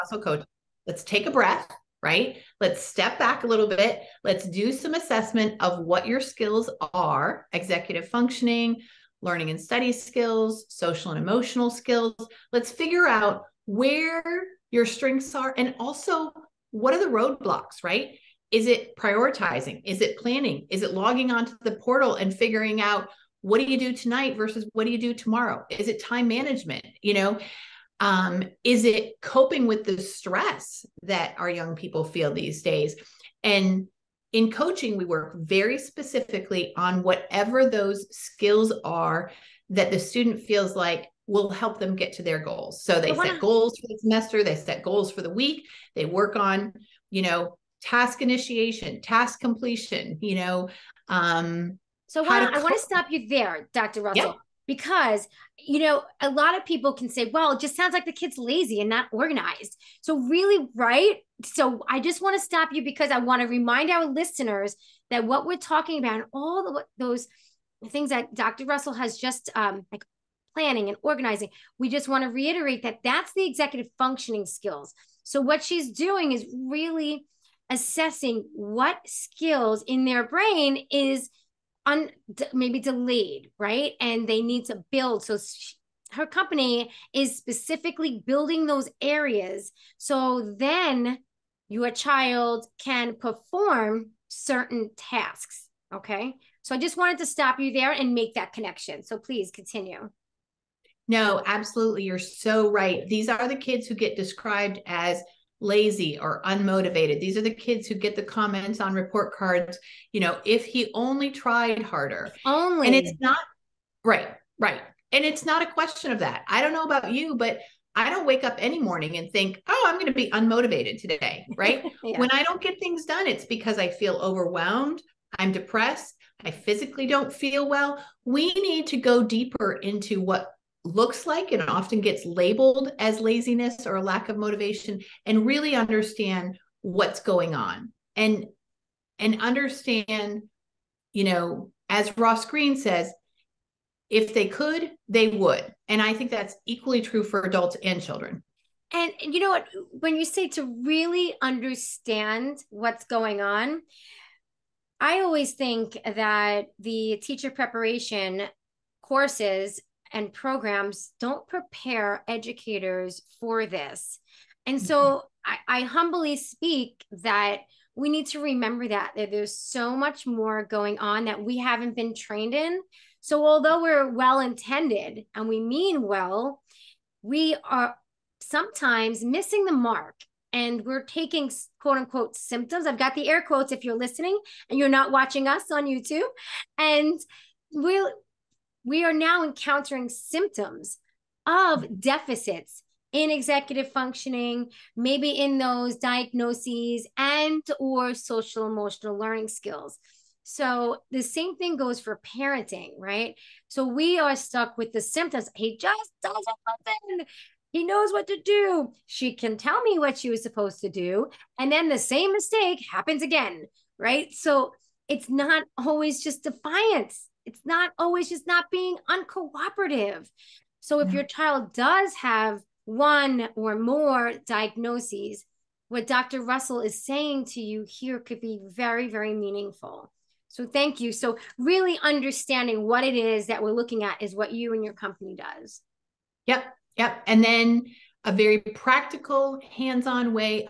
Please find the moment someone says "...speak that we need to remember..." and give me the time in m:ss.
2:46.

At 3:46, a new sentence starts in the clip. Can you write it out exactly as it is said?
Russell is saying to you here could be very, very meaningful.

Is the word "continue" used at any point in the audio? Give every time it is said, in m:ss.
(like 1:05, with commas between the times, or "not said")
1:39.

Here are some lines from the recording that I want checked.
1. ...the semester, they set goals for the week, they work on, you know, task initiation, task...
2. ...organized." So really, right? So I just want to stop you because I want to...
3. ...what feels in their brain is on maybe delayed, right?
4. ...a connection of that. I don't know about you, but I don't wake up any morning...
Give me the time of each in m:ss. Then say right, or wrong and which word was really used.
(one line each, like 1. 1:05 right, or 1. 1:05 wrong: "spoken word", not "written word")
1. 0:43 right
2. 0:59 right
3. 1:18 wrong: "skills", not "feels"
4. 1:55 wrong: "question", not "connection".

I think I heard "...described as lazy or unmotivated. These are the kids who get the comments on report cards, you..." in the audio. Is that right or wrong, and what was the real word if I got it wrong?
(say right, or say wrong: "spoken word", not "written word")
right.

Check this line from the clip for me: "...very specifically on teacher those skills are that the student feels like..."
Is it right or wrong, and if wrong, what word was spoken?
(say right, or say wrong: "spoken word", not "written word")
wrong: "whatever", not "teacher".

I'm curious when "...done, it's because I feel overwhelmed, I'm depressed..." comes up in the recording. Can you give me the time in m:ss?
2:03.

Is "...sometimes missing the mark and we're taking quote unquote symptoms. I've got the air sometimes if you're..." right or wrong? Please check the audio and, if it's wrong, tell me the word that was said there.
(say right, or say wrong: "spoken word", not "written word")
wrong: "quotes", not "sometimes".